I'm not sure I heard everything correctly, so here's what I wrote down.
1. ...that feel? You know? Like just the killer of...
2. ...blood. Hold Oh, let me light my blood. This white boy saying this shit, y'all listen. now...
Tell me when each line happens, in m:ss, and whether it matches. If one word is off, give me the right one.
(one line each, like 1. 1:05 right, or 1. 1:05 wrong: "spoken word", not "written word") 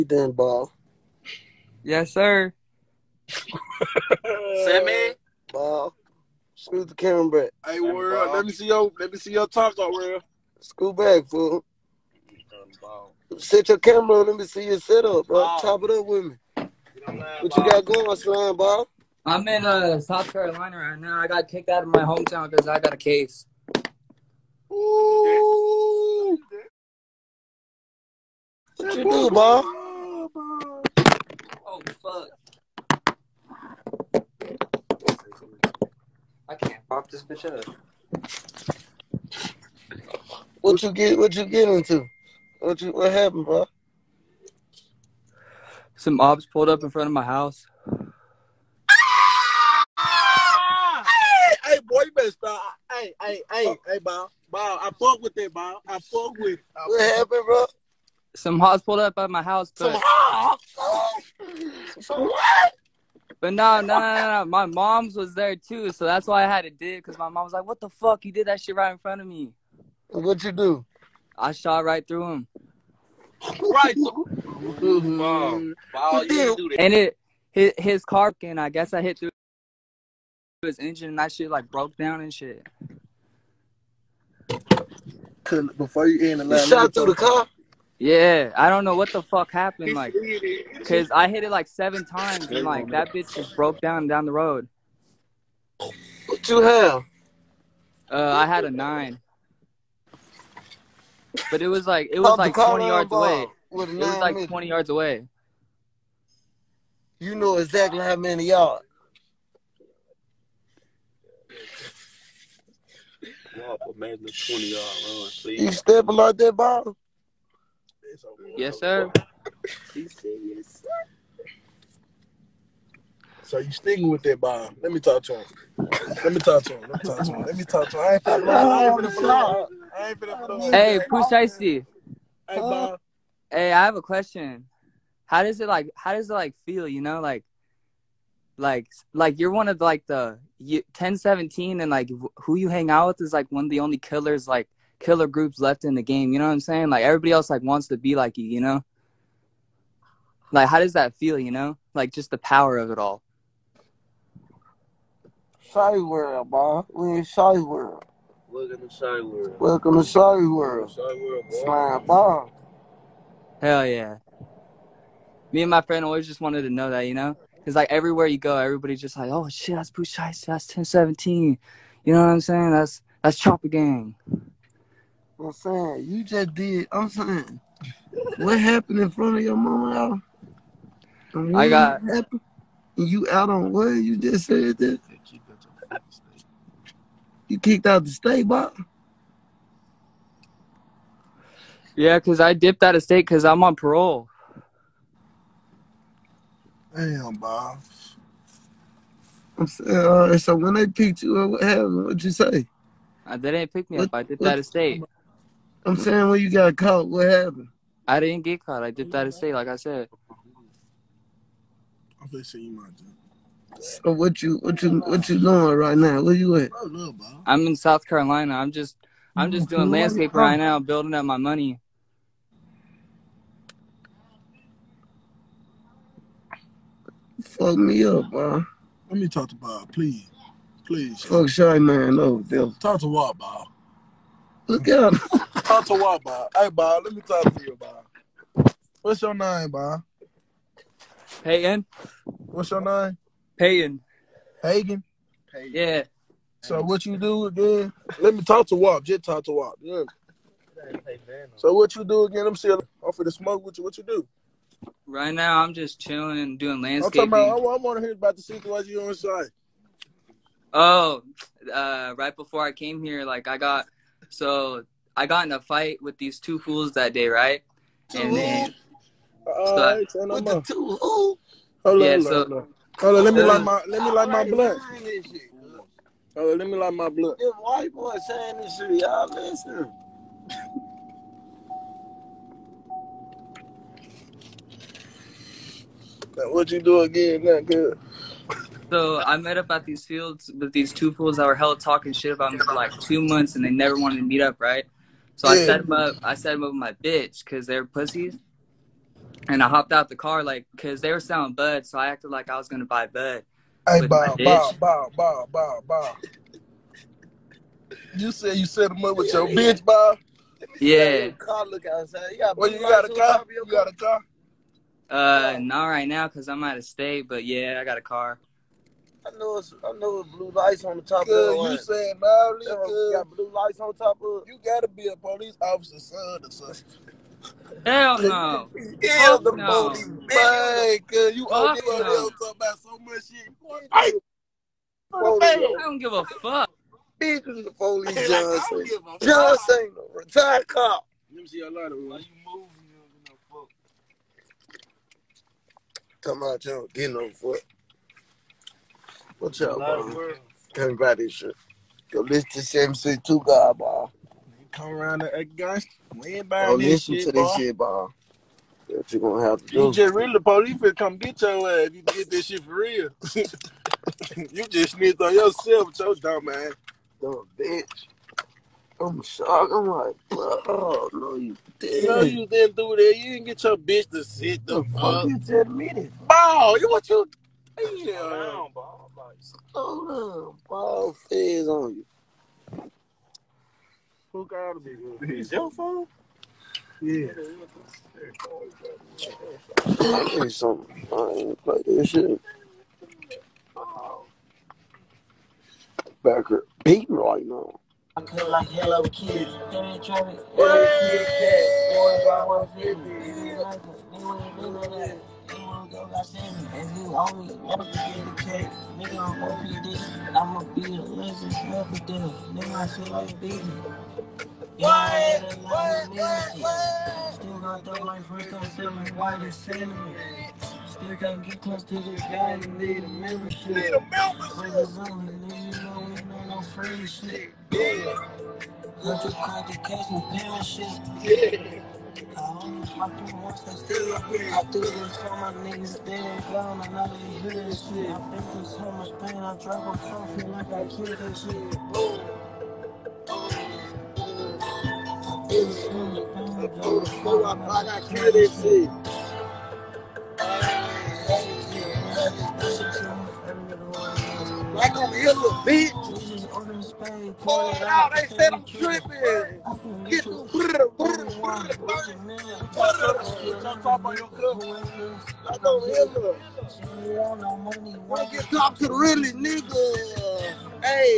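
1. 2:30 wrong: "power", not "killer"
2. 4:34 right.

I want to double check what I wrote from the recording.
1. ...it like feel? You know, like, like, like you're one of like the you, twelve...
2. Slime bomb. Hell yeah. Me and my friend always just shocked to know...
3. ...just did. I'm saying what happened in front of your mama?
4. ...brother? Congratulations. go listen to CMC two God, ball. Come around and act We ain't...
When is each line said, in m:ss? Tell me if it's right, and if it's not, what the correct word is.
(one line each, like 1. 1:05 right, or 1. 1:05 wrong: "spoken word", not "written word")
1. 2:16 wrong: "ten", not "twelve"
2. 2:41 wrong: "wanted", not "shocked"
3. 2:56 right
4. 5:49 right.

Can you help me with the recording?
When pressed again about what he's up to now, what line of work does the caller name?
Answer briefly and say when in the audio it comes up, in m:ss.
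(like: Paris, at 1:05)
landscaping, at 4:16.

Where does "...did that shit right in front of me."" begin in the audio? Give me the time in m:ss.
1:08.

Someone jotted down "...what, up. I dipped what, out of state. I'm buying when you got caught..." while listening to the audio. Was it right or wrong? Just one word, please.
wrong.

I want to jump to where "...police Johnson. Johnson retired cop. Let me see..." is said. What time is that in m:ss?
5:37.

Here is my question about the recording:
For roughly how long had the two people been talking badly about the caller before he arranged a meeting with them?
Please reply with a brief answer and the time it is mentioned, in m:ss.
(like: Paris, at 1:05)
2 months, at 4:52.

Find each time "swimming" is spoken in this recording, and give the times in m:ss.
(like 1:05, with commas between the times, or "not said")
not said.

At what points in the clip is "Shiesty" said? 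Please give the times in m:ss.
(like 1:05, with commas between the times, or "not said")
2:11, 2:50.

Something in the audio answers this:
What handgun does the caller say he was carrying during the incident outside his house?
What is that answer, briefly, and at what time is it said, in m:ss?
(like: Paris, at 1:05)
a nine, at 1:38.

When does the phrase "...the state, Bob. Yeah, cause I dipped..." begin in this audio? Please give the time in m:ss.
3:08.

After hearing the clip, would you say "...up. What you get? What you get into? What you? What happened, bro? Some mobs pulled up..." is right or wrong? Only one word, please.
right.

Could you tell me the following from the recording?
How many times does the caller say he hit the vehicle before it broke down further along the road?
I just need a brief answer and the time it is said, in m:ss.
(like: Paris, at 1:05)
7, at 1:31.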